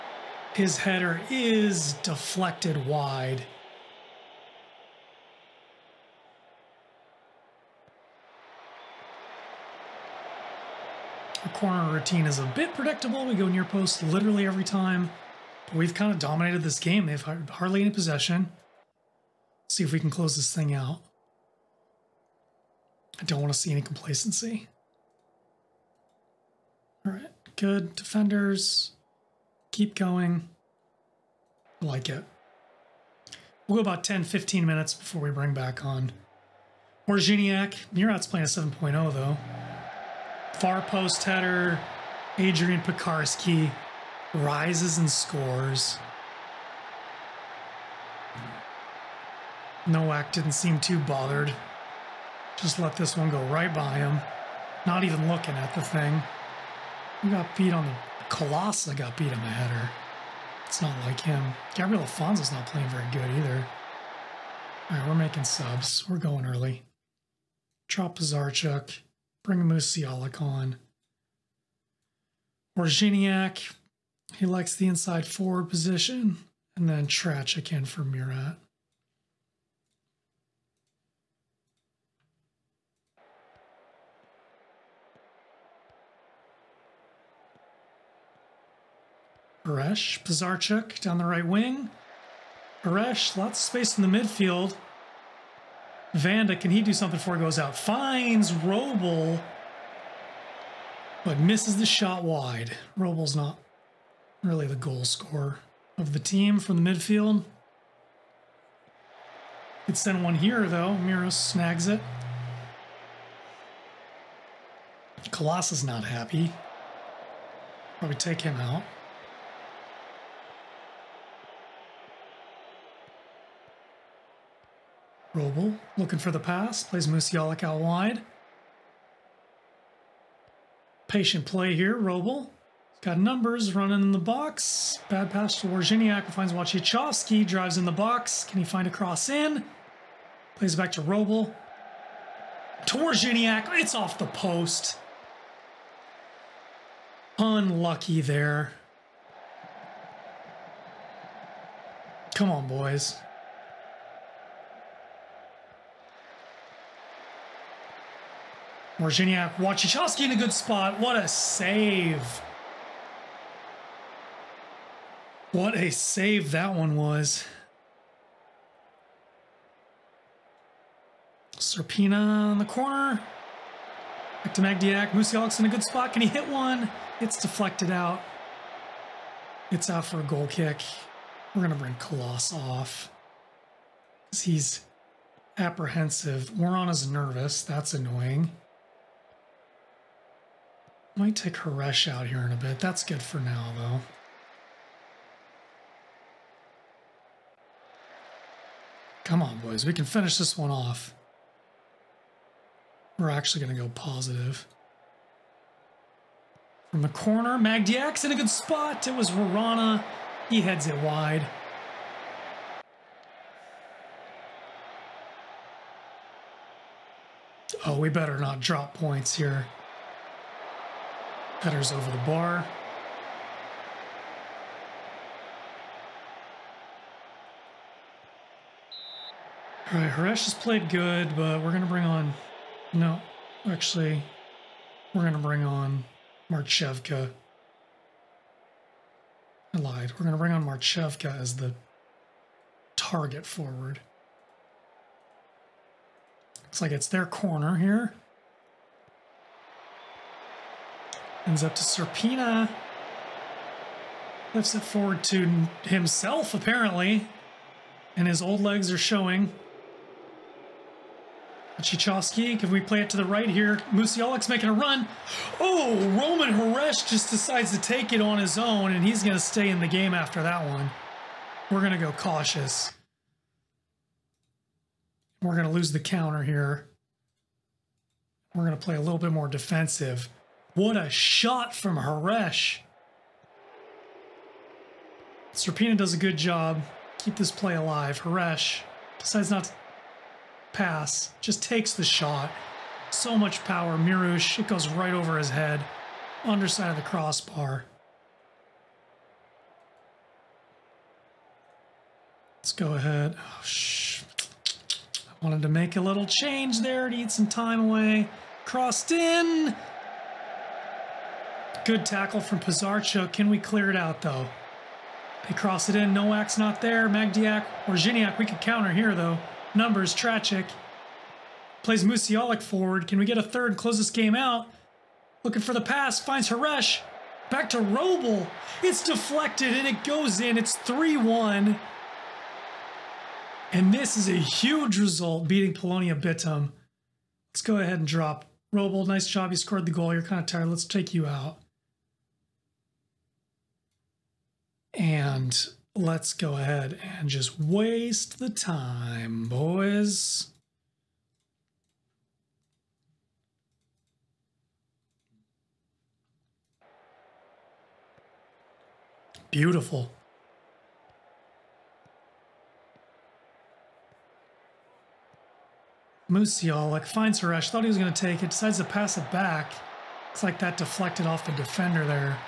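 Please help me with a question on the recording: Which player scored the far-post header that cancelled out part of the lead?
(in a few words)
Adrian Pekarski.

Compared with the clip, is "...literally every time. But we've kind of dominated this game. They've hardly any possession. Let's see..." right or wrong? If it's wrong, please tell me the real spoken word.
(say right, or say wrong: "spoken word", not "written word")
right.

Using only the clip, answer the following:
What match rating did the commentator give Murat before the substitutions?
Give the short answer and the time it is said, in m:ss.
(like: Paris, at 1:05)
7.0, at 0:38.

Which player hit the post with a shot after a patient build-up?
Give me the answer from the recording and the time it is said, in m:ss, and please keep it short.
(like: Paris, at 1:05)
Wozniak, at 2:22.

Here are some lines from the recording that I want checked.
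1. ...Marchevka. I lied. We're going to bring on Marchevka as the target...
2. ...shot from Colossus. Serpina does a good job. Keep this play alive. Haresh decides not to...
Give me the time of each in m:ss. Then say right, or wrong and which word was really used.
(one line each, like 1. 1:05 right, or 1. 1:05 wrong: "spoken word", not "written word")
1. 3:56 right
2. 4:41 wrong: "Haresh", not "Colossus".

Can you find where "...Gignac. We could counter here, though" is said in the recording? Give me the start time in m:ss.
5:17.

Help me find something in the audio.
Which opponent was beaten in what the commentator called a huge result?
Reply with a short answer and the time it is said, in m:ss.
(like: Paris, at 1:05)
Polonia Bytom, at 5:35.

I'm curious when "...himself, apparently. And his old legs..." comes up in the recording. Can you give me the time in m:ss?
4:15.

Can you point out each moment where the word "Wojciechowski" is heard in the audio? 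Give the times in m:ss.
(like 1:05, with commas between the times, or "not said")
2:16, 2:39.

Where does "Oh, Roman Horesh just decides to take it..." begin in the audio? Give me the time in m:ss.
4:25.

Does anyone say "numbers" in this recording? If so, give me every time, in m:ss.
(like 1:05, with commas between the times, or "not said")
2:13, 5:19.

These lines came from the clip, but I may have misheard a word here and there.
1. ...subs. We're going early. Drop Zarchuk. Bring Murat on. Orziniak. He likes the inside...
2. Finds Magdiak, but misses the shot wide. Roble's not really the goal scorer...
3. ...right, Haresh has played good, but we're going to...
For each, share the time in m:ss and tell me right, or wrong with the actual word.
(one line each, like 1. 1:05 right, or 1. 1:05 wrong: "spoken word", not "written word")
1. 1:05 wrong: "Musialik", not "Murat"
2. 1:37 wrong: "Roble", not "Magdiak"
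3. 3:49 right.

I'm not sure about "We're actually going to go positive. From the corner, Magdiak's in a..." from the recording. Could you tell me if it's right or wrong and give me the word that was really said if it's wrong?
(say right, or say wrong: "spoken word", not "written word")
right.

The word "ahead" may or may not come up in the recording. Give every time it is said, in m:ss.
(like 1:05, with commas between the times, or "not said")
5:02, 5:37, 5:46.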